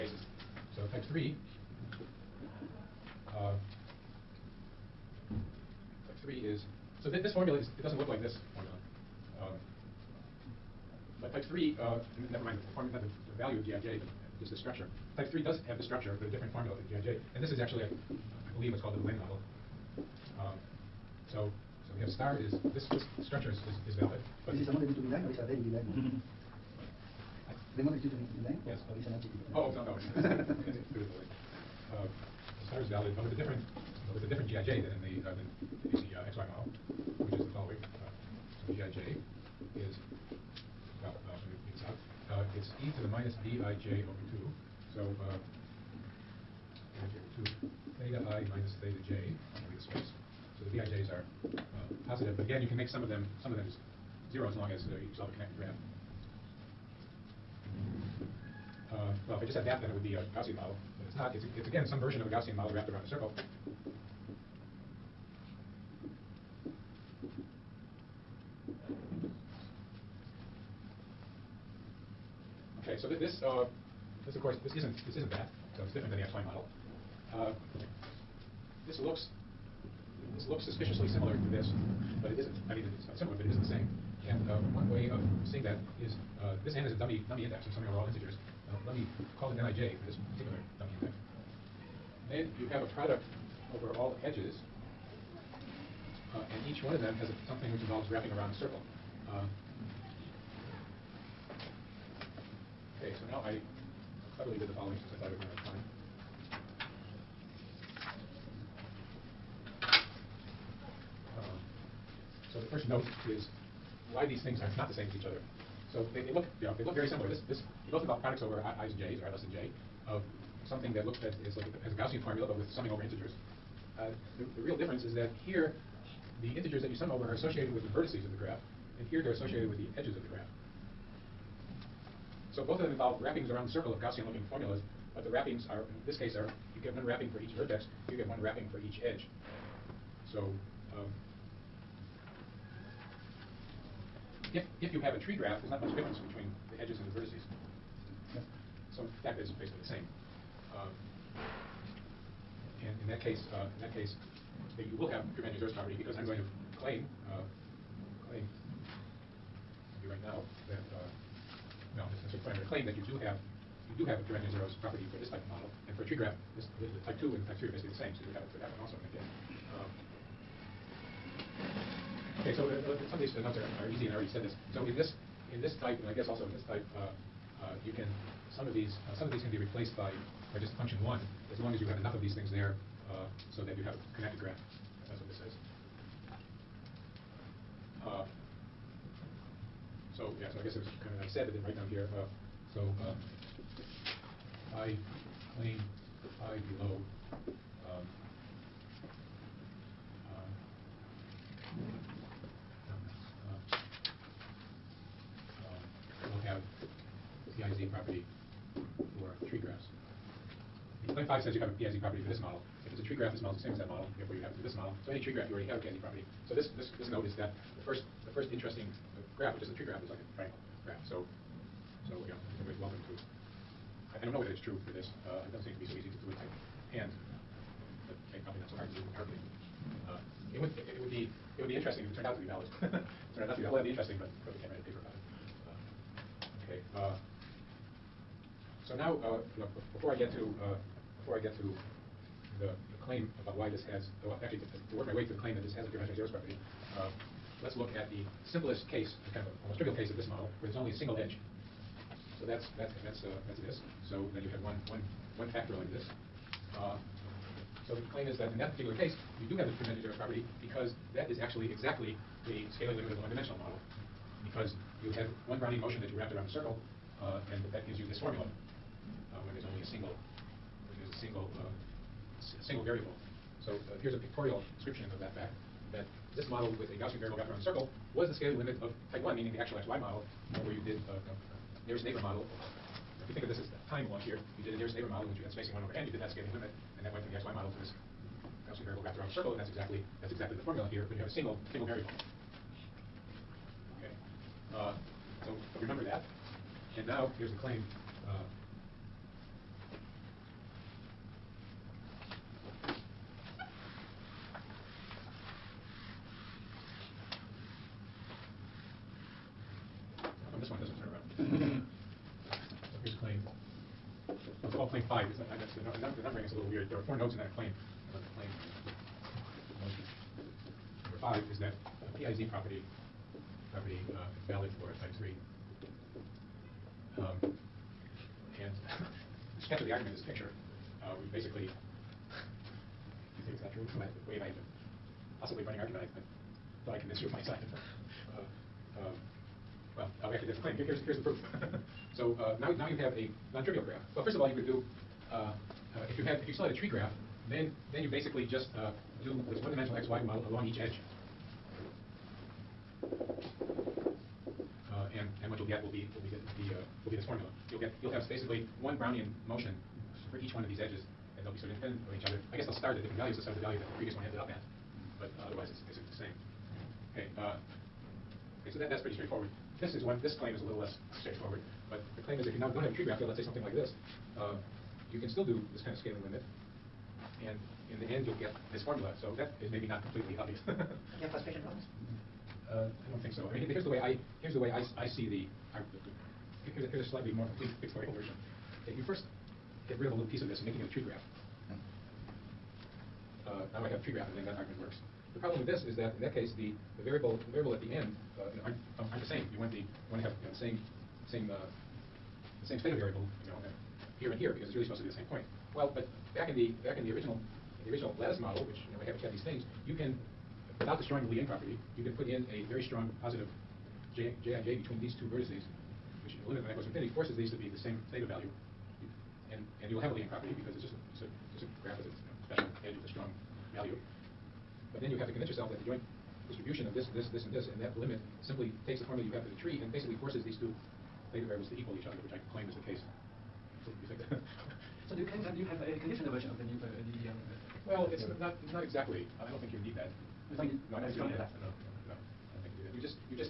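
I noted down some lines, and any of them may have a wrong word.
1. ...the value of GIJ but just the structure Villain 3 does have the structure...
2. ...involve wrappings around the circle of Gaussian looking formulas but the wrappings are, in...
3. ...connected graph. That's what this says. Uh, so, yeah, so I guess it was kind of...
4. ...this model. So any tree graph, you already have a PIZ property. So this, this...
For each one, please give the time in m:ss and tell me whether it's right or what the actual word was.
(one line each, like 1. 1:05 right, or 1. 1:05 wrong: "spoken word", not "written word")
1. 0:13 wrong: "Type", not "Villain"
2. 2:12 right
3. 3:04 right
4. 3:34 right.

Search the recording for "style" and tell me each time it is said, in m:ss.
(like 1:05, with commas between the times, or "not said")
not said.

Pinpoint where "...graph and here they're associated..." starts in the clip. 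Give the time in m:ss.
2:08.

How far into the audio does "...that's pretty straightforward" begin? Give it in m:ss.
6:08.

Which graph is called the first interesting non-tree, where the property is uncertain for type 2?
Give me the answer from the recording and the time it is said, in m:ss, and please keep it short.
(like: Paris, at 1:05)
triangle graph, at 3:40.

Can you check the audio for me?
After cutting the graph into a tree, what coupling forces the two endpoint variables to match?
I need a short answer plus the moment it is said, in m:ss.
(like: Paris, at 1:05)
very strong positive J, at 6:52.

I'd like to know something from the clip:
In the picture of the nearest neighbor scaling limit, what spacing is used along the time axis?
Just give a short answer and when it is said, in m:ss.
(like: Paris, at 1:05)
1 over n, at 4:45.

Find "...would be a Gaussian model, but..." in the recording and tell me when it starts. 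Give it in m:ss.
0:59.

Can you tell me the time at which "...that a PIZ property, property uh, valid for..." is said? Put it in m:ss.
5:21.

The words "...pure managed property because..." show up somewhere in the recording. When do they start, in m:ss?
2:35.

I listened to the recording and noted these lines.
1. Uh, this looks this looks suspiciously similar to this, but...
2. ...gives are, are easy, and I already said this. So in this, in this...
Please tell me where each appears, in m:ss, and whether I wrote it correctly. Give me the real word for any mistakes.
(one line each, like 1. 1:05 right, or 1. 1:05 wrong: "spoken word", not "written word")
1. 1:17 right
2. 2:53 wrong: "notes", not "gives".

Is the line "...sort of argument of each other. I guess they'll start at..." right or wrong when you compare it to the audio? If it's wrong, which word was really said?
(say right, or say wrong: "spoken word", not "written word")
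wrong: "independent", not "argument".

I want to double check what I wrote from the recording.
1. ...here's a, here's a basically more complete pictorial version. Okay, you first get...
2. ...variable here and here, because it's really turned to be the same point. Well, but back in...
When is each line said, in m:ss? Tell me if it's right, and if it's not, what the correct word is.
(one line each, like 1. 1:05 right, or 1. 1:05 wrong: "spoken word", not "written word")
1. 6:26 wrong: "slightly", not "basically"
2. 6:42 wrong: "supposed", not "turned".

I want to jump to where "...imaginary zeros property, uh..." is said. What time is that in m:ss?
4:05.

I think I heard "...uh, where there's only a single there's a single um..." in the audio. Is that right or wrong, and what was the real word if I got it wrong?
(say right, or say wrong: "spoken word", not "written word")
right.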